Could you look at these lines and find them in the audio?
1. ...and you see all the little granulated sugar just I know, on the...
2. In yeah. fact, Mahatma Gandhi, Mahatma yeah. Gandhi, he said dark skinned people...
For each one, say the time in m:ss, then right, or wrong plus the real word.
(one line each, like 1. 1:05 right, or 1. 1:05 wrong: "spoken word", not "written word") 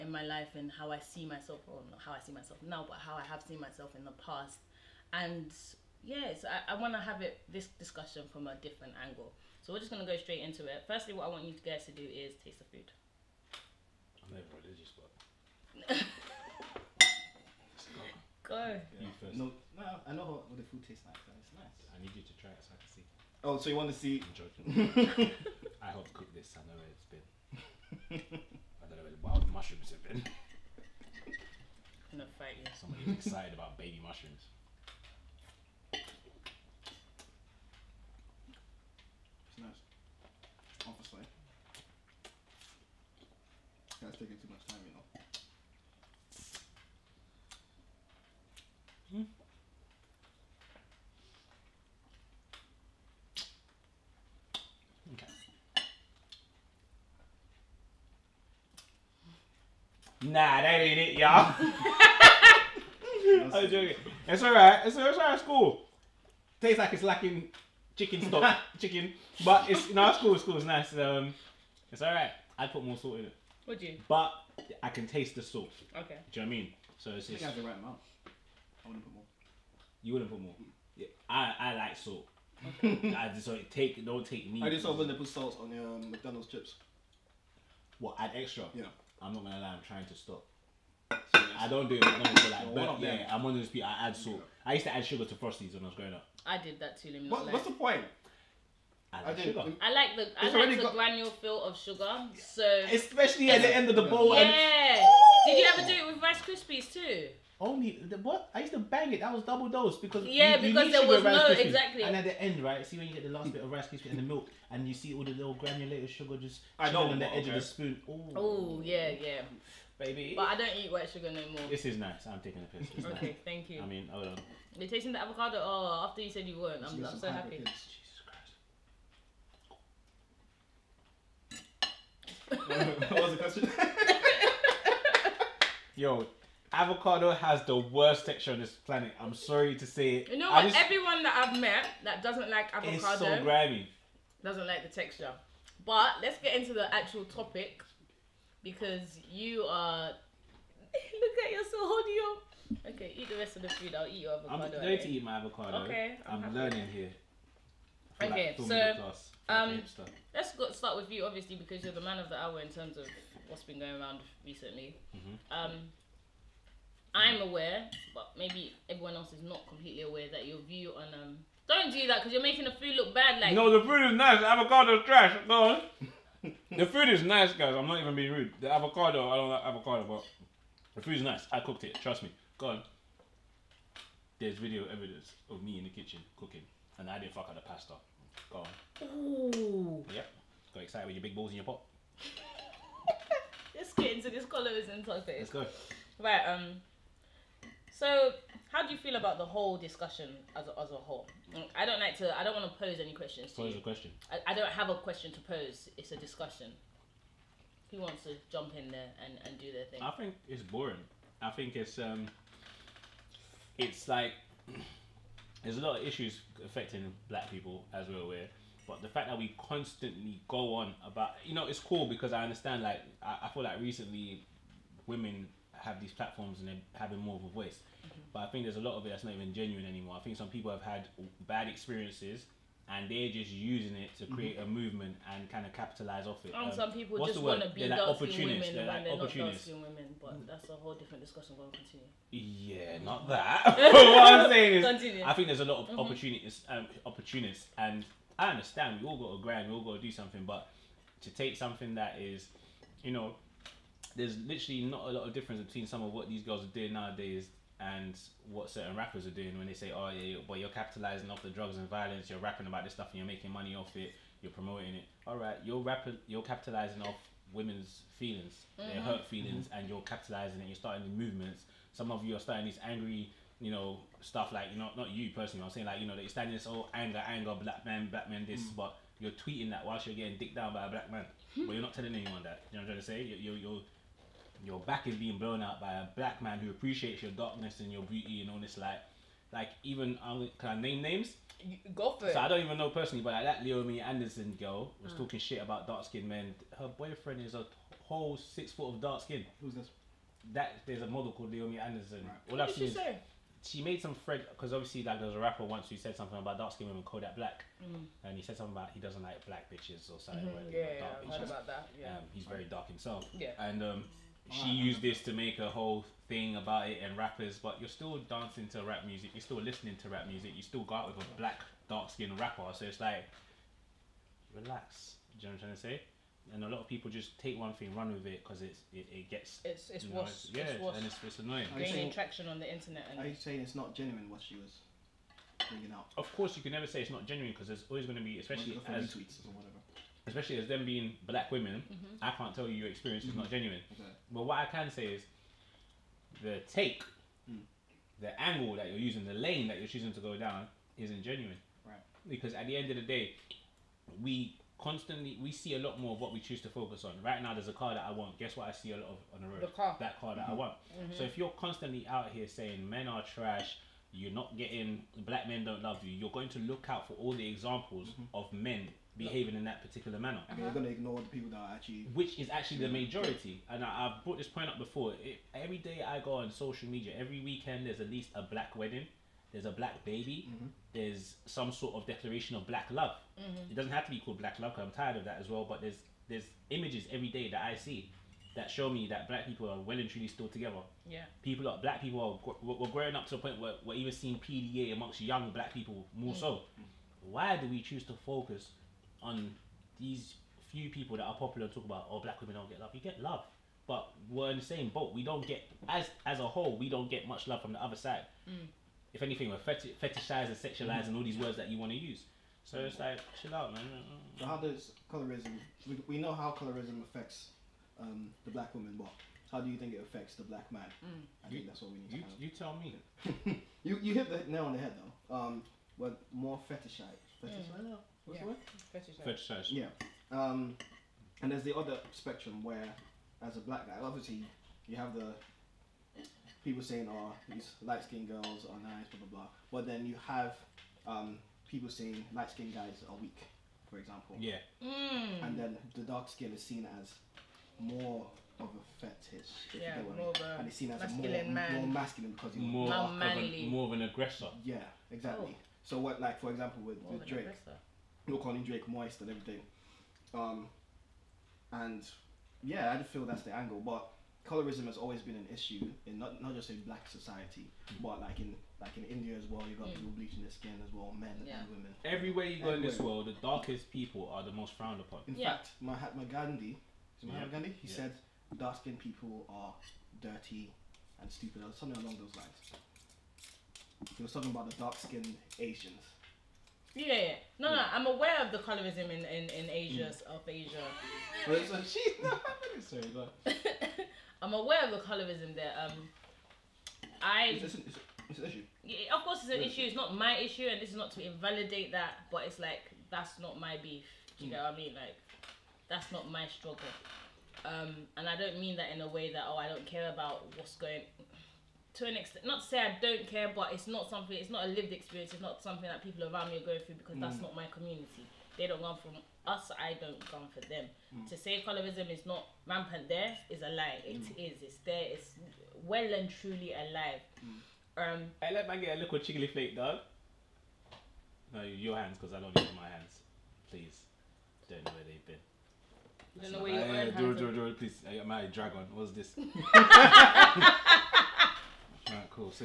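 1. 1:54 right
2. 7:55 right.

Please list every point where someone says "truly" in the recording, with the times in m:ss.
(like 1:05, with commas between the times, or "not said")
6:30, 8:46.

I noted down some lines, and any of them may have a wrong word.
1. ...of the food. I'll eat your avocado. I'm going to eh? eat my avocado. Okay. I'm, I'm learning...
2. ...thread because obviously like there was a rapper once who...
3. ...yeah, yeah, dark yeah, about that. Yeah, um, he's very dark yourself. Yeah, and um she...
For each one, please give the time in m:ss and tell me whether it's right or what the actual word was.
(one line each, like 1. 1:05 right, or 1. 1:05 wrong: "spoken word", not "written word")
1. 2:33 right
2. 5:04 right
3. 5:10 wrong: "himself", not "yourself".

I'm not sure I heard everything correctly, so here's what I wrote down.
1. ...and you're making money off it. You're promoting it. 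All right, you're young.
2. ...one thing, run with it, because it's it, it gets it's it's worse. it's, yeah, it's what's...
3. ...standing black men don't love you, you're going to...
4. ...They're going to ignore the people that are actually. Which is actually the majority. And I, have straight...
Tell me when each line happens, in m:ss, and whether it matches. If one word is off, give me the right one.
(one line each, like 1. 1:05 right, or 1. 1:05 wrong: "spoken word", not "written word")
1. 4:23 wrong: "rapping", not "young"
2. 5:27 right
3. 6:04 wrong: "getting", not "standing"
4. 6:10 wrong: "brought", not "straight".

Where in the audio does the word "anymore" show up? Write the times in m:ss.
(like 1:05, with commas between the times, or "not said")
3:49.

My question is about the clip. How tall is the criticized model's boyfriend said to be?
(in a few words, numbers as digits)
six foot.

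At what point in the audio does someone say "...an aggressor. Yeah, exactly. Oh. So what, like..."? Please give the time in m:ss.
7:33.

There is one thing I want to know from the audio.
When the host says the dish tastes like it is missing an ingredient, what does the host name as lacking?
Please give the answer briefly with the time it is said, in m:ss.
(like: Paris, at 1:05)
chicken stock, at 1:07.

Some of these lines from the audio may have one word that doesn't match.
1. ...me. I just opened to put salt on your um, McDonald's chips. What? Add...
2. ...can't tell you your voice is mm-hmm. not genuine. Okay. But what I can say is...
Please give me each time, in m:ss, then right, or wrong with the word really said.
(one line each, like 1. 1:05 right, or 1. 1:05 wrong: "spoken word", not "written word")
1. 1:24 right
2. 5:42 wrong: "experience", not "voice".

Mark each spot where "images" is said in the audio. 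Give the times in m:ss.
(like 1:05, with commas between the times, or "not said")
6:26.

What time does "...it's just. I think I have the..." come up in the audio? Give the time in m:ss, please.
1:17.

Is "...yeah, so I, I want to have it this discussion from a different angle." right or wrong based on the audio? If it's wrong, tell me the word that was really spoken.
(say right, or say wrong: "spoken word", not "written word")
right.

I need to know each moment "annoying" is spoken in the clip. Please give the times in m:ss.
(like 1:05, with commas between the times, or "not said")
5:31.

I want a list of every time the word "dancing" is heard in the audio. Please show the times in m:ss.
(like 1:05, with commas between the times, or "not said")
5:18.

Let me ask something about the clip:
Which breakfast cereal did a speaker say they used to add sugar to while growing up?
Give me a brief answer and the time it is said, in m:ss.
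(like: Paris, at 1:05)
Frosties, at 1:35.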